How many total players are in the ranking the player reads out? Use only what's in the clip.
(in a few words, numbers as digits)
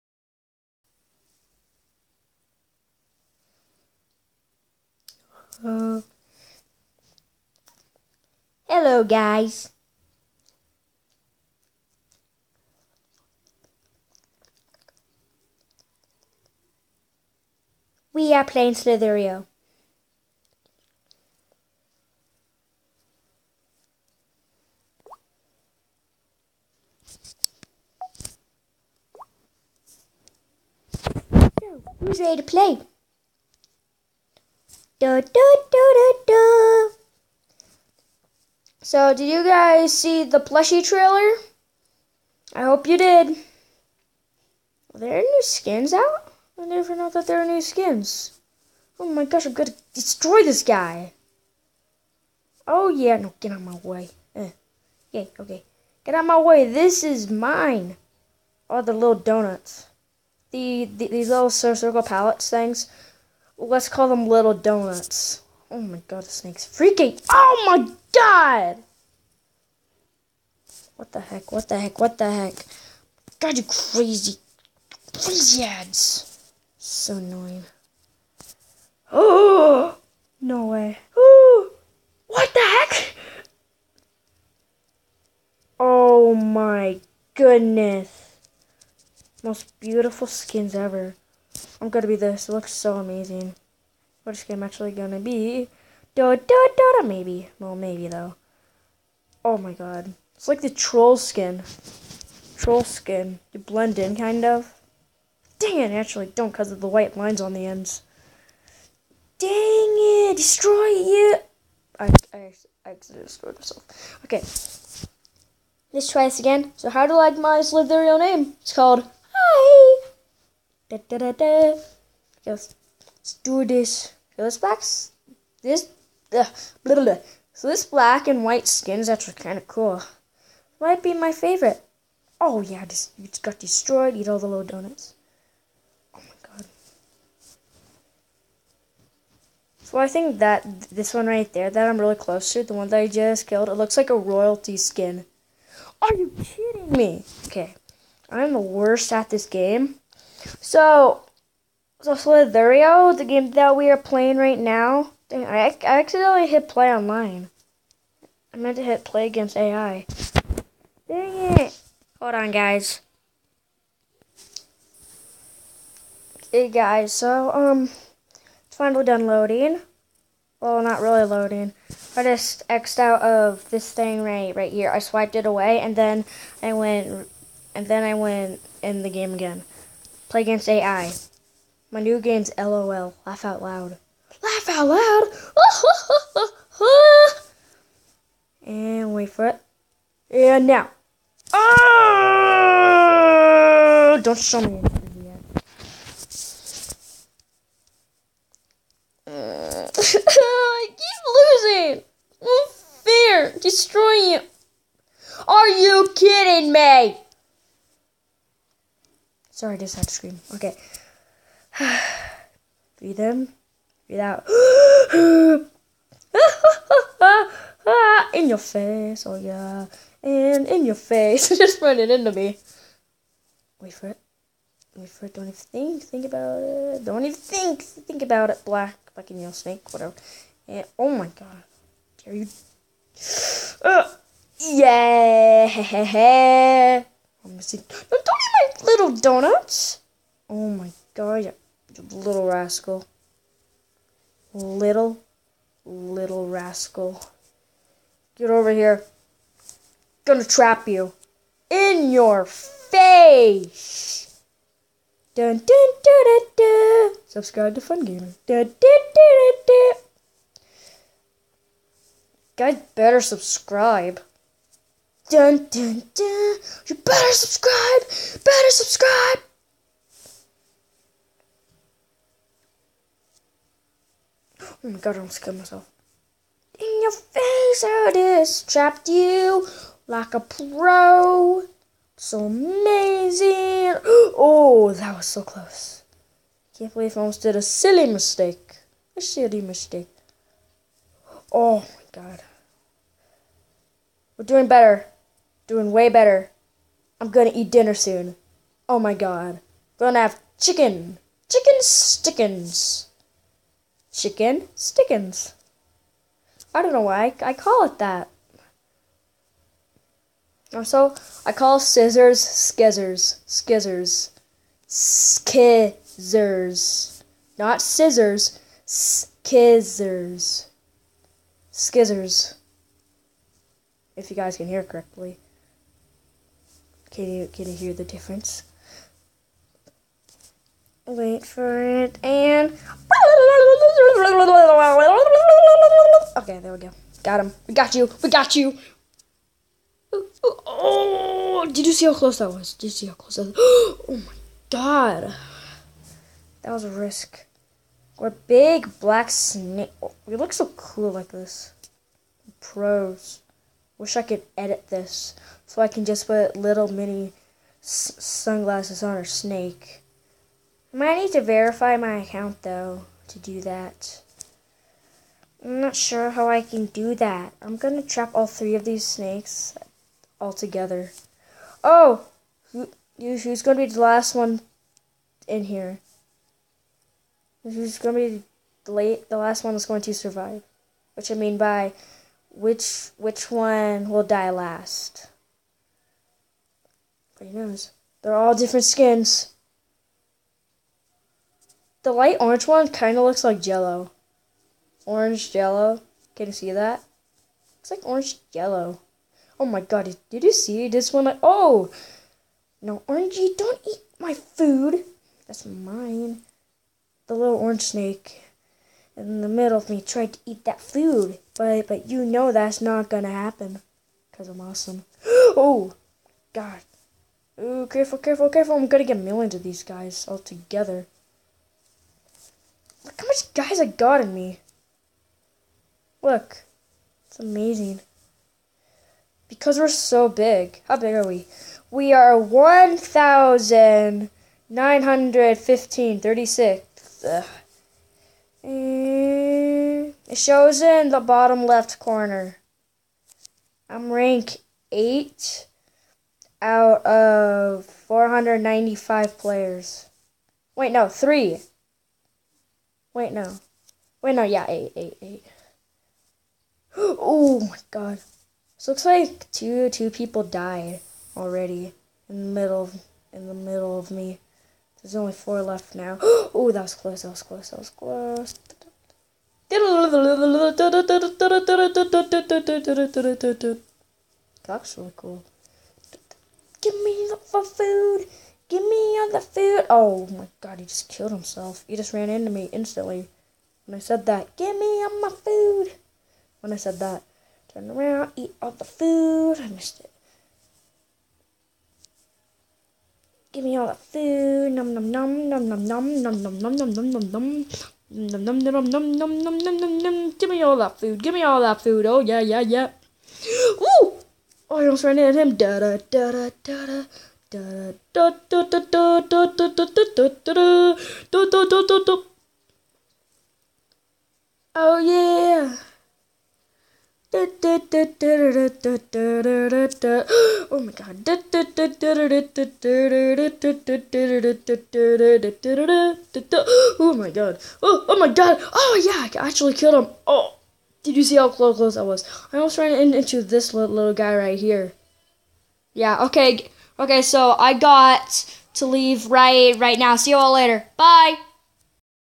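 495.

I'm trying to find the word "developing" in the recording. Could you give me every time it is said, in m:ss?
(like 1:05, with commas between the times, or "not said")
not said.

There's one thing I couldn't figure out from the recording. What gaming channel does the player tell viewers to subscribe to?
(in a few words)
Fun Gaming.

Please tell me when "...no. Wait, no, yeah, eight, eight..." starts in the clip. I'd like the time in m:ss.
7:33.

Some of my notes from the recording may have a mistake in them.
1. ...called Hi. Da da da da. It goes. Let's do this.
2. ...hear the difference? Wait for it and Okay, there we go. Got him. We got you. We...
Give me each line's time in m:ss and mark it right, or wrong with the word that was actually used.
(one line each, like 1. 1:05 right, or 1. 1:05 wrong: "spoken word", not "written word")
1. 1:58 right
2. 5:27 right.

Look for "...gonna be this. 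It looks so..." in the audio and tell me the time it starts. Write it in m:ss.
1:31.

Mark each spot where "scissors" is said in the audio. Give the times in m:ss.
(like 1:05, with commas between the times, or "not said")
5:11, 5:17.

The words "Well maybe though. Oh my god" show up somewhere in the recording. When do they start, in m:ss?
1:37.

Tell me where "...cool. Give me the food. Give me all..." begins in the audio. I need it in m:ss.
7:55.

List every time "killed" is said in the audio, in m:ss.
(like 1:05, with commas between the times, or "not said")
2:23, 4:35, 8:01, 8:49.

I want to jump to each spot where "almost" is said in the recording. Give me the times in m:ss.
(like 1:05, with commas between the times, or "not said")
4:35, 4:47, 8:24, 8:52.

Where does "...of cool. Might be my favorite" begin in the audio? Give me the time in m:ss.
2:09.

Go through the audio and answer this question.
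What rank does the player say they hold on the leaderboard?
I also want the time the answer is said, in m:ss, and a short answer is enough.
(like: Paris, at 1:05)
8, at 7:23.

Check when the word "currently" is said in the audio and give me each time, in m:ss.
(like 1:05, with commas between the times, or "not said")
not said.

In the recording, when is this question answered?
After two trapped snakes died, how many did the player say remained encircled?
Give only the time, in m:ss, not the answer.
7:45.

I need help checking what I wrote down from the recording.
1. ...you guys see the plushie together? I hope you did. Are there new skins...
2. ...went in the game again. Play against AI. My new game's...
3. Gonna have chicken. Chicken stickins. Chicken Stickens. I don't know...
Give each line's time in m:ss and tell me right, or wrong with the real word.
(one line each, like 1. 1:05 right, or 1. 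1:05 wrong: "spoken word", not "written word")
1. 0:39 wrong: "trailer", not "together"
2. 2:58 right
3. 4:59 right.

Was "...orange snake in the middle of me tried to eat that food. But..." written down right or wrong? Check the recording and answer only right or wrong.
right.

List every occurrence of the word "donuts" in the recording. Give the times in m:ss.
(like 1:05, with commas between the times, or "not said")
0:59, 1:04, 2:14, 3:59.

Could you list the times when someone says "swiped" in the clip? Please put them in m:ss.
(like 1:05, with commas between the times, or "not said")
2:54.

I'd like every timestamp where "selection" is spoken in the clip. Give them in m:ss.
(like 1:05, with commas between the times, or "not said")
not said.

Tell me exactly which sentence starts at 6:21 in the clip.
Which I mean by which which one will die last?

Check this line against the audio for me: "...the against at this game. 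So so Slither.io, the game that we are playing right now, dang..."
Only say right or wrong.
wrong.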